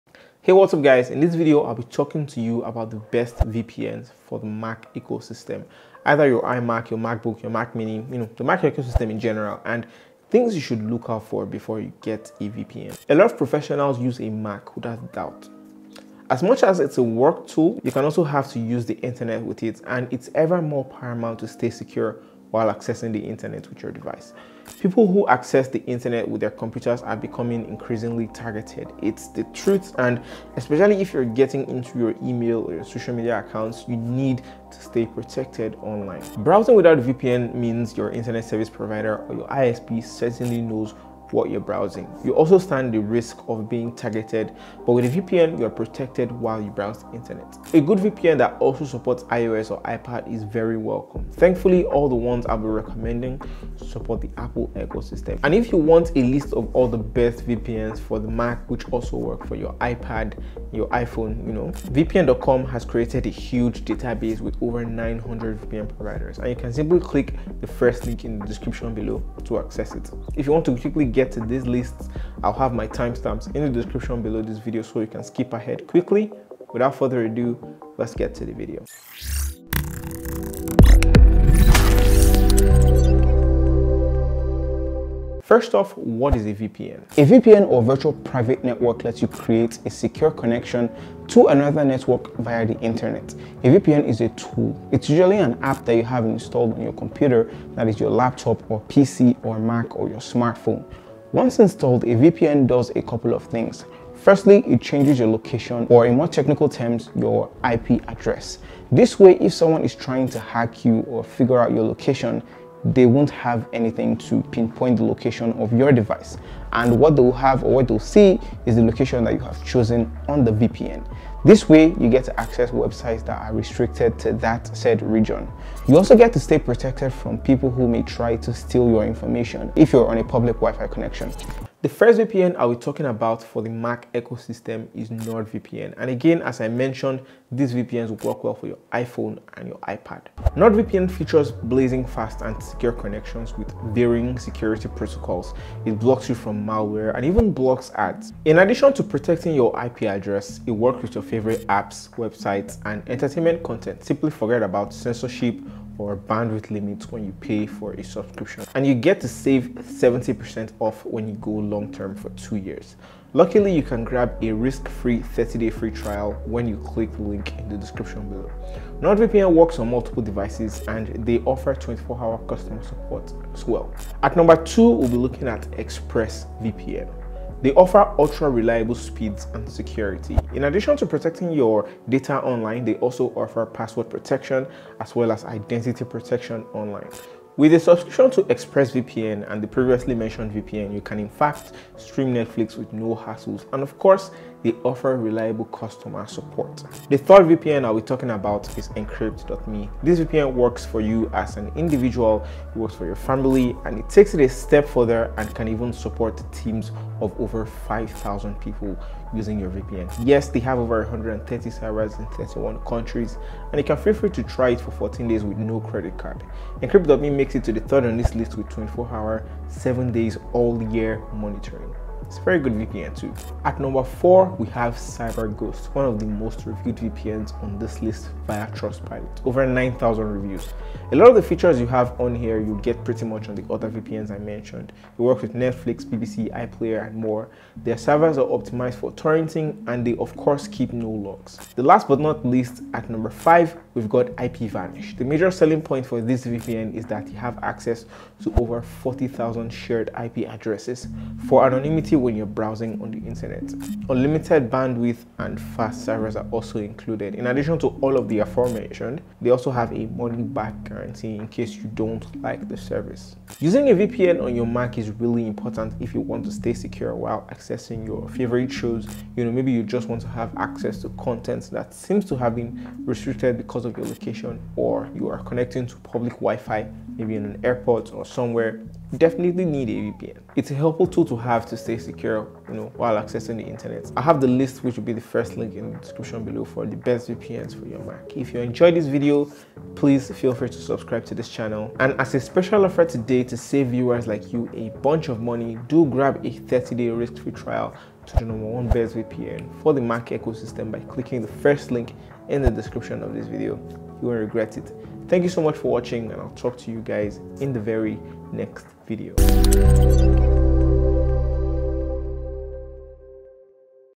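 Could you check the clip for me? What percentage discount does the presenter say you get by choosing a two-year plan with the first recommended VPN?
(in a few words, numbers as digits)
70%.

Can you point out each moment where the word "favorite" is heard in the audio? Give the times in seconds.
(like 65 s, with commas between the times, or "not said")
151 s, 268 s.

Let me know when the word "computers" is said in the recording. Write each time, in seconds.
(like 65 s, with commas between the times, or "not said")
26 s, 96 s.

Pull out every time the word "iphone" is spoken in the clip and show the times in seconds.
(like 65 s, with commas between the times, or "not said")
60 s, 138 s.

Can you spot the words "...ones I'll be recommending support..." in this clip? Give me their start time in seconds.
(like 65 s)
52 s.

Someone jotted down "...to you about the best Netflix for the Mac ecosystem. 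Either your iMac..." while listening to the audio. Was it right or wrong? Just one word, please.
wrong.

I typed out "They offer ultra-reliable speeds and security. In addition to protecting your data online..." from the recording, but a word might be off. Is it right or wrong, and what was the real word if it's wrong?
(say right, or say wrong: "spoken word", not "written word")
right.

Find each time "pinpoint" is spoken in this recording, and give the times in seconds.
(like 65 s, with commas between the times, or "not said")
114 s.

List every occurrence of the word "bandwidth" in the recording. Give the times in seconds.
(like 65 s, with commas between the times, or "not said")
156 s, 254 s.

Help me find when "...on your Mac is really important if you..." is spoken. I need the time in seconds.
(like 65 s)
264 s.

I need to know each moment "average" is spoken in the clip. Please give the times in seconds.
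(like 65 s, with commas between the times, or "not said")
not said.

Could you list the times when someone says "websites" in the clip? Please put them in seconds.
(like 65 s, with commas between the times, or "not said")
122 s, 152 s.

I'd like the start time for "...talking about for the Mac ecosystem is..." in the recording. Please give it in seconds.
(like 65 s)
132 s.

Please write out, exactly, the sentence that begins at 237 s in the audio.
Their servers are optimized for torrenting, and they of course keep no logs.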